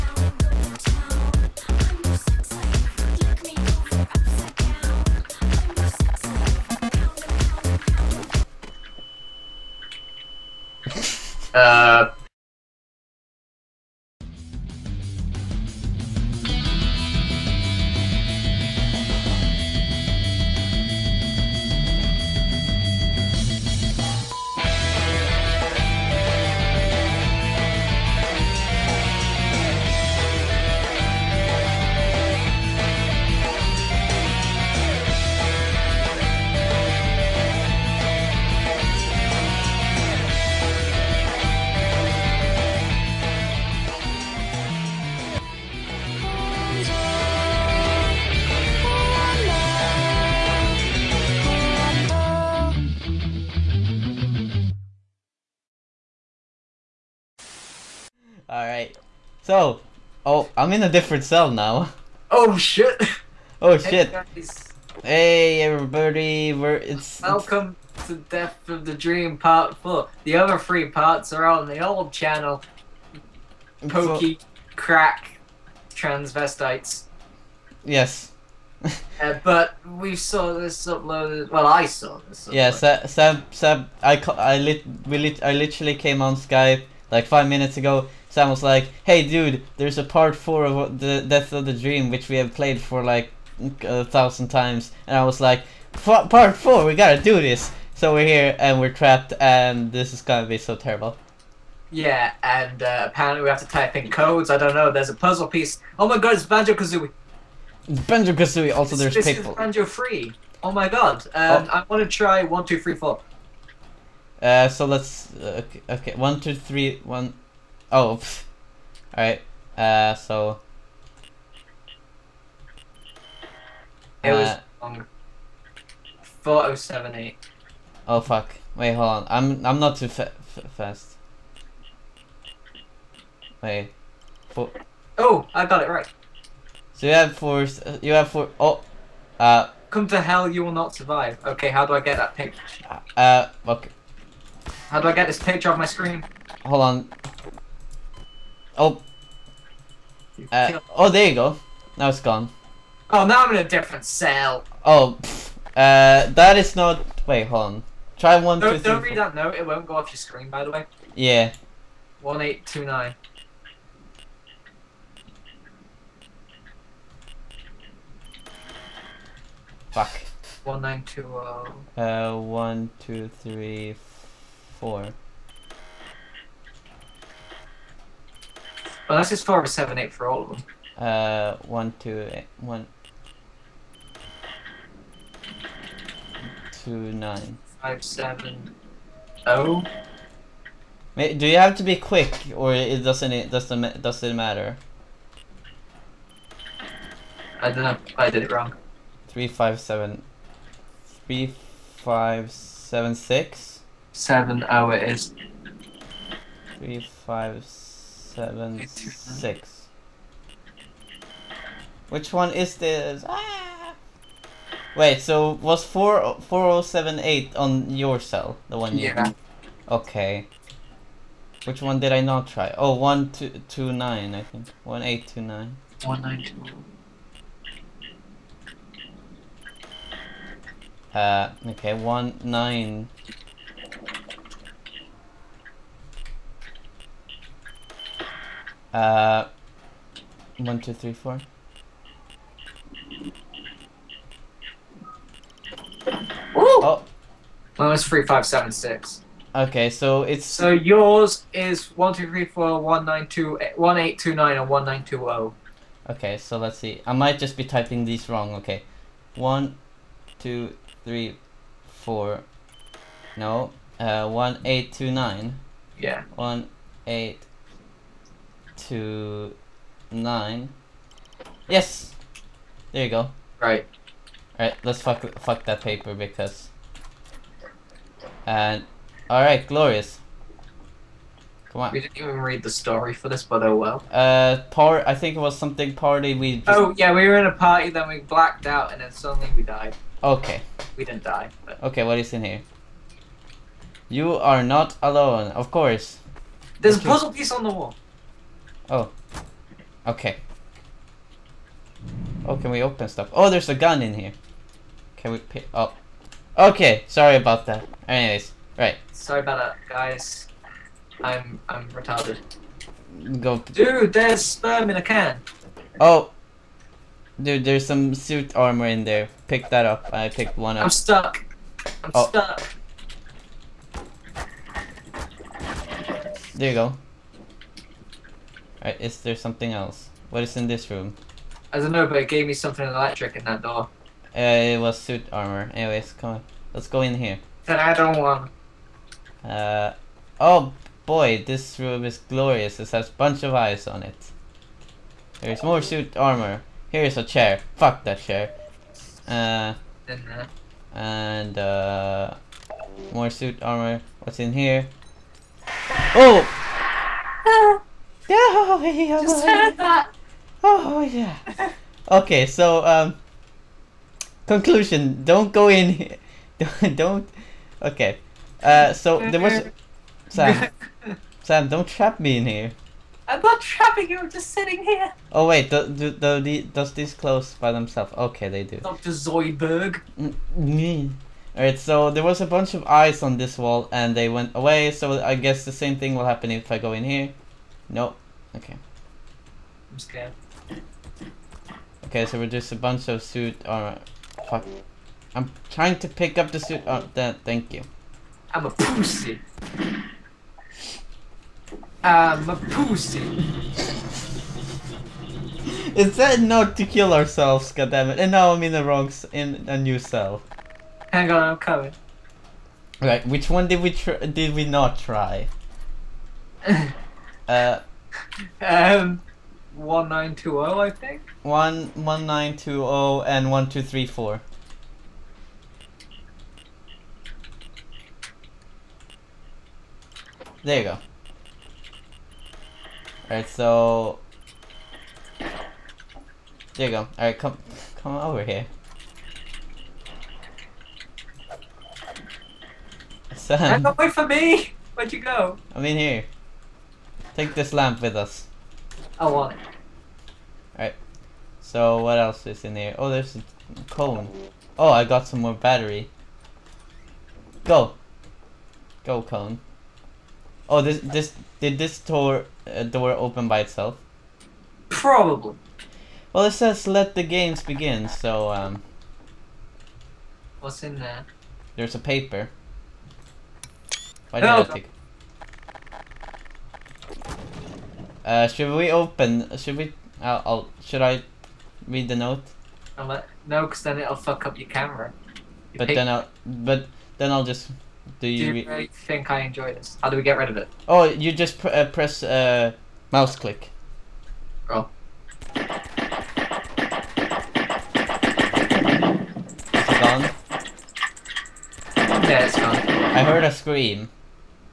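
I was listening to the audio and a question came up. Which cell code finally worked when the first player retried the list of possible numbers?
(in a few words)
1829.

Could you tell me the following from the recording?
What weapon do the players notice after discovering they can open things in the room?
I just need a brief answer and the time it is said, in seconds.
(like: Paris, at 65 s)
a gun, at 303 s.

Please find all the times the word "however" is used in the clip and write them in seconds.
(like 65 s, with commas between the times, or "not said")
not said.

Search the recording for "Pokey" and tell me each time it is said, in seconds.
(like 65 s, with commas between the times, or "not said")
73 s.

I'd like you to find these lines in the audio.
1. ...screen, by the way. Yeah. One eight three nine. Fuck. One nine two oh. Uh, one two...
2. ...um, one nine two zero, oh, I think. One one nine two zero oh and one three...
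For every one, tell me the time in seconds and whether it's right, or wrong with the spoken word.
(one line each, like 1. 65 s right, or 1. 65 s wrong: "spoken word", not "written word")
1. 160 s wrong: "two", not "three"
2. 418 s wrong: "two", not "three".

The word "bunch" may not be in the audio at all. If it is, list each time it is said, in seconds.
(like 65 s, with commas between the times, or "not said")
343 s, 382 s, 392 s.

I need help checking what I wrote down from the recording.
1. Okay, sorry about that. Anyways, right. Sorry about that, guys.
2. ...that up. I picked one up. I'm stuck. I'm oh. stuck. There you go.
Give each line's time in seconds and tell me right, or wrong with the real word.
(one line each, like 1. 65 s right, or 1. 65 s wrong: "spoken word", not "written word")
1. 306 s right
2. 319 s right.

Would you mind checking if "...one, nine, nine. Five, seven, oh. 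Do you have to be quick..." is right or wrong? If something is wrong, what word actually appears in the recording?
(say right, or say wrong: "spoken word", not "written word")
wrong: "two", not "nine".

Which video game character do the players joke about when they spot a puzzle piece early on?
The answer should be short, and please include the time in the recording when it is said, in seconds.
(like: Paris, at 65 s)
Banjo Kazooie, at 105 s.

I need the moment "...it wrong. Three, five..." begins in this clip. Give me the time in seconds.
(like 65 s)
198 s.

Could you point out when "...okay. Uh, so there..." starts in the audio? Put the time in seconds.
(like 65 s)
367 s.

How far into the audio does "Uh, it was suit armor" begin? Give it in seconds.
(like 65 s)
334 s.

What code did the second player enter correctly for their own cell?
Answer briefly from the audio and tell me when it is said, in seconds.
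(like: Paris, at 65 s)
3576, at 247 s.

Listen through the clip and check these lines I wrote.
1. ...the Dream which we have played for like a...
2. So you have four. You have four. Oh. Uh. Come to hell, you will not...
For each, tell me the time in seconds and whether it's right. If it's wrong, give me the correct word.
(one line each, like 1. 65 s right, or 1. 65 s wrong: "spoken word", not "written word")
1. 91 s right
2. 136 s right.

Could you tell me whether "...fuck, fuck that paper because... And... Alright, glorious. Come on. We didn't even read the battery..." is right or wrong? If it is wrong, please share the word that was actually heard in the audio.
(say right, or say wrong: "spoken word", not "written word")
wrong: "story", not "battery".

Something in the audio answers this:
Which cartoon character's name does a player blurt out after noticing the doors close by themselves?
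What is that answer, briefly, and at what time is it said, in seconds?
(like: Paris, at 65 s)
Doctor Zoidberg, at 378 s.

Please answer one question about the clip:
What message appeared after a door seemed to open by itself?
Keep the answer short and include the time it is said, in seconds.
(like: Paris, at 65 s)
let the games begin, at 466 s.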